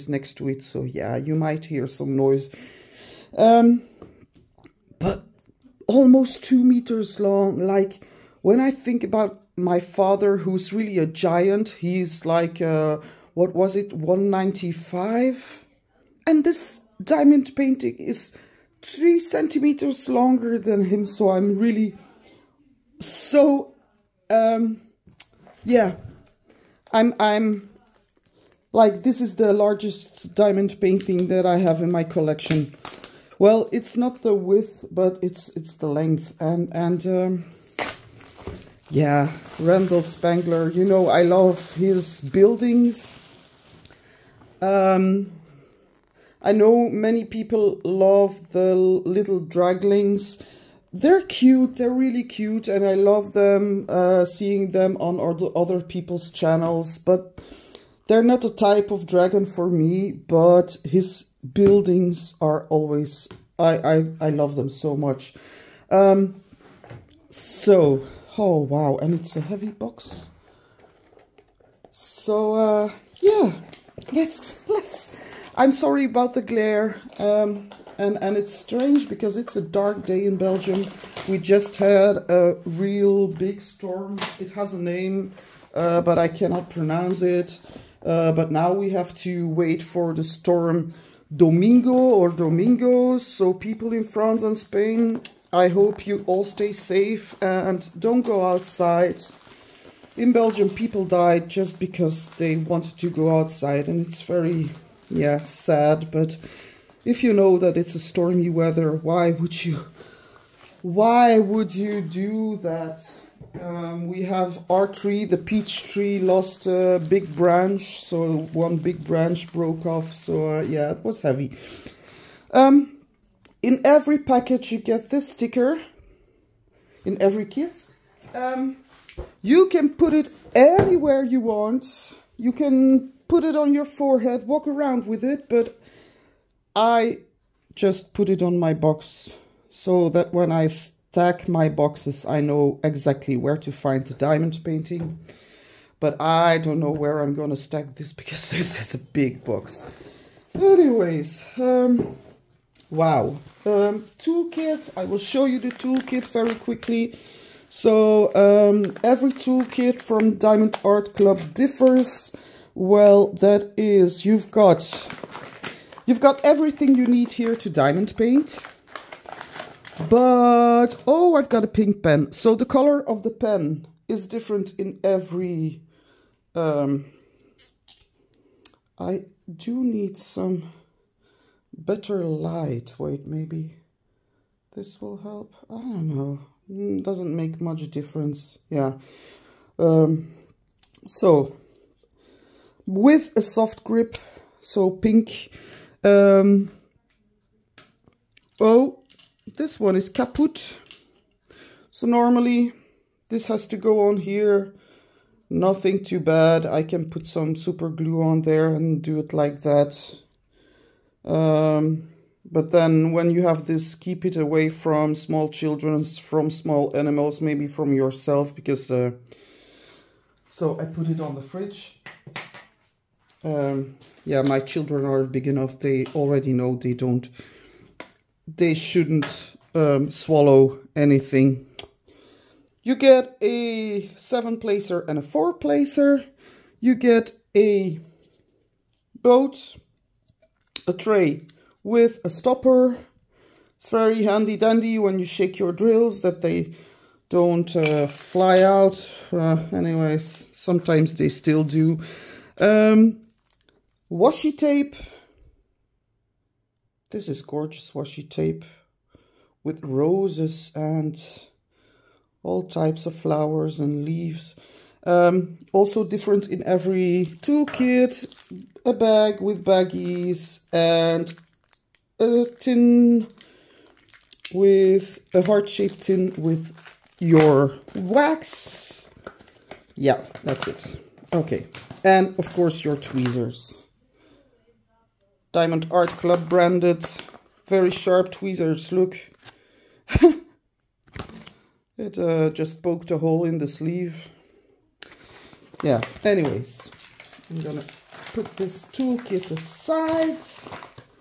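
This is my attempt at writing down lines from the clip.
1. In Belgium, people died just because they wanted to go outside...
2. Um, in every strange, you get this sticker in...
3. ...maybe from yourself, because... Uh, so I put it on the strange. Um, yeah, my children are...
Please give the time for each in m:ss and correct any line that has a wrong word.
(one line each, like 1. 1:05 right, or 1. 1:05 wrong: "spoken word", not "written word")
1. 1:40 right
2. 2:02 wrong: "package", not "strange"
3. 3:37 wrong: "fridge", not "strange".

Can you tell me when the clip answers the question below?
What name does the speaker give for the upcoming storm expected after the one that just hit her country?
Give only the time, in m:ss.
1:31.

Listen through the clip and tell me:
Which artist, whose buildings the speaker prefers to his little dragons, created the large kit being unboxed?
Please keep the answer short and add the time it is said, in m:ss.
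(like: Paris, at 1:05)
Randal Spangler, at 0:39.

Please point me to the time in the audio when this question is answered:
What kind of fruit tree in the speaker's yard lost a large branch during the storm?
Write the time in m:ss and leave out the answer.
1:55.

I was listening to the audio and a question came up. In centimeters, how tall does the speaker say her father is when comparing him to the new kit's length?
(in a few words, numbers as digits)
195.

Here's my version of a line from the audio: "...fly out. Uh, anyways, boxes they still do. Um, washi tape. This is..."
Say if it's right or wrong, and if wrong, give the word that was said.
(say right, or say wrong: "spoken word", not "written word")
wrong: "sometimes", not "boxes".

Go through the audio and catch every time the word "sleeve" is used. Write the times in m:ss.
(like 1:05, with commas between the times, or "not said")
4:53.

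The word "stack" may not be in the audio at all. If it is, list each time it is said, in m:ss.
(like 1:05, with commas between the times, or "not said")
2:20, 2:27.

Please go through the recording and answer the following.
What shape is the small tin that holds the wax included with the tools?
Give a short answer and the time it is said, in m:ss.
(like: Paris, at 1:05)
Heart-shaped, at 4:35.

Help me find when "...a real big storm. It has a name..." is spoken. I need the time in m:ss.
1:22.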